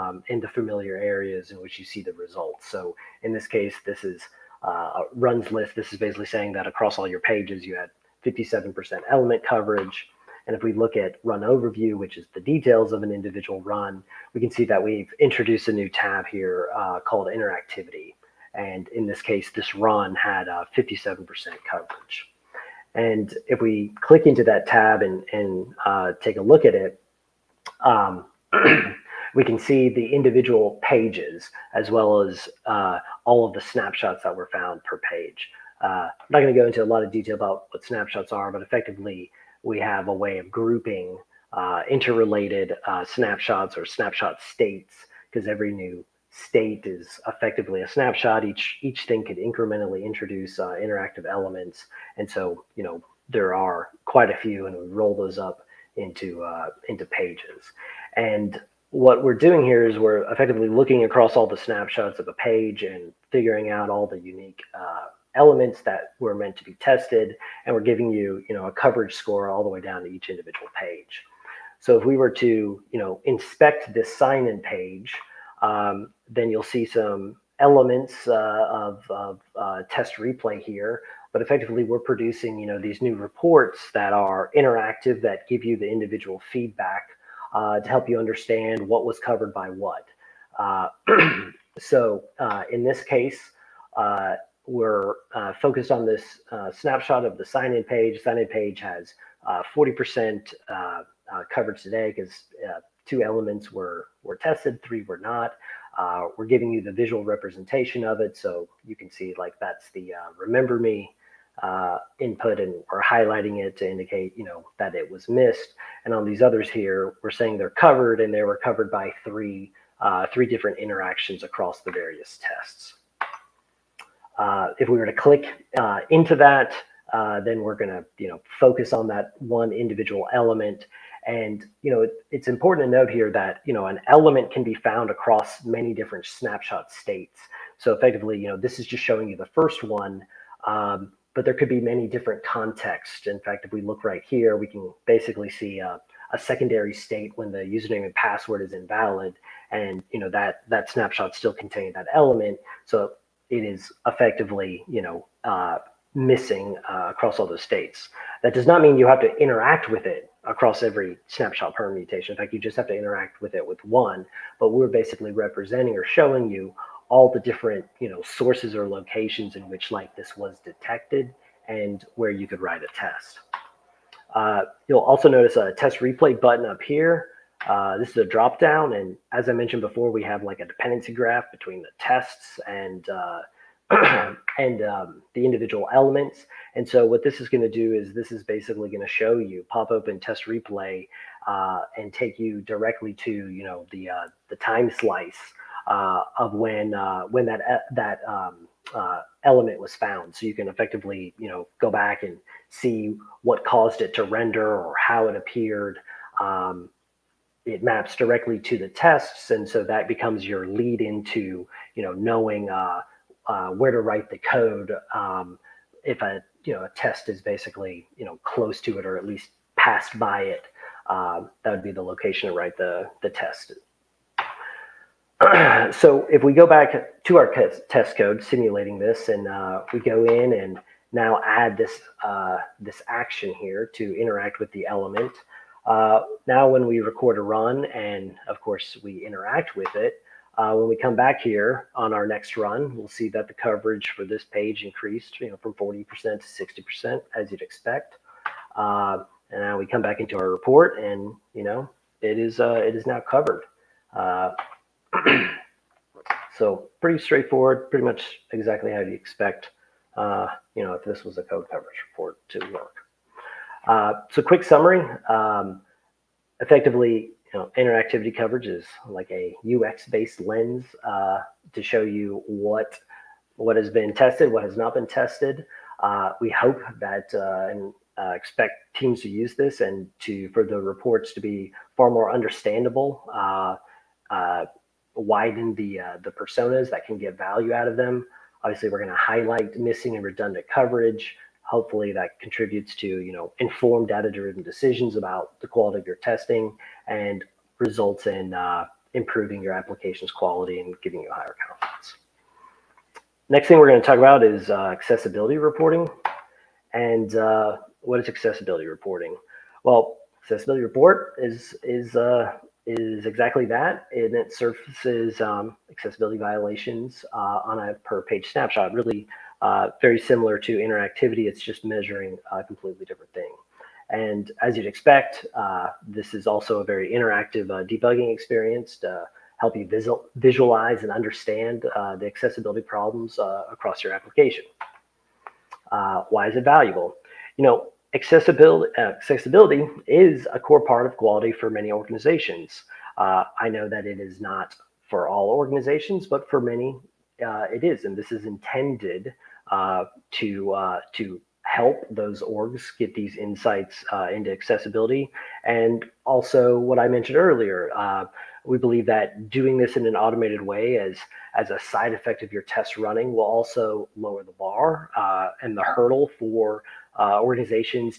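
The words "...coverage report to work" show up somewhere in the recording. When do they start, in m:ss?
4:21.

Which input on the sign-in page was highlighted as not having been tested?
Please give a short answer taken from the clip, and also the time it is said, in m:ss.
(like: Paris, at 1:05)
remember me, at 1:50.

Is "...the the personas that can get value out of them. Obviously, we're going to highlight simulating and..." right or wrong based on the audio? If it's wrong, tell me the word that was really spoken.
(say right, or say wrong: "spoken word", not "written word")
wrong: "missing", not "simulating".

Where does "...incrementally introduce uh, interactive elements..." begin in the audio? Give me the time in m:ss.
0:49.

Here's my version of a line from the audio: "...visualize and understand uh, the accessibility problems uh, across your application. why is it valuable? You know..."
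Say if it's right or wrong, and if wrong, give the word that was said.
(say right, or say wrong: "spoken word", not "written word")
right.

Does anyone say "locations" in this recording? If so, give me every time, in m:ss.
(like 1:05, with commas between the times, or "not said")
2:48, 3:42.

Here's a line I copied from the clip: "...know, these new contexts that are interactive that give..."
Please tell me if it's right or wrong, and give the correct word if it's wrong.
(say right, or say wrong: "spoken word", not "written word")
wrong: "reports", not "contexts".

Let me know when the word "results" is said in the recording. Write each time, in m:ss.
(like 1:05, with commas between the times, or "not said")
0:02, 4:57.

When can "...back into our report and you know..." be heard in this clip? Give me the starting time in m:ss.
4:10.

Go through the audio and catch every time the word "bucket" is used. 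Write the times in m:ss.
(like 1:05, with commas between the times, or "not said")
not said.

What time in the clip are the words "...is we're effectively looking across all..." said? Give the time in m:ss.
0:59.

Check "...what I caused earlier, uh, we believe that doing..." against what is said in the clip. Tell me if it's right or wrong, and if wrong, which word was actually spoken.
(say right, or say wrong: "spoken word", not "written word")
wrong: "mentioned", not "caused".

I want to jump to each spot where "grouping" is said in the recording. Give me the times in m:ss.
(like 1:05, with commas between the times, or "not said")
0:40.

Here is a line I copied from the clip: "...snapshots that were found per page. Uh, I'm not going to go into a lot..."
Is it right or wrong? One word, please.
right.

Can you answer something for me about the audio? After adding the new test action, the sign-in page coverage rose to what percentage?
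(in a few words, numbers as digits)
60%.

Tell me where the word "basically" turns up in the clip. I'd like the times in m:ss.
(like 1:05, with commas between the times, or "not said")
0:06, 2:25, 2:44, 3:08, 3:37.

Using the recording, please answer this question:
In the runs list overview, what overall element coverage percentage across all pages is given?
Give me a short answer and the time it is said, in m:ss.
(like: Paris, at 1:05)
57%, at 0:08.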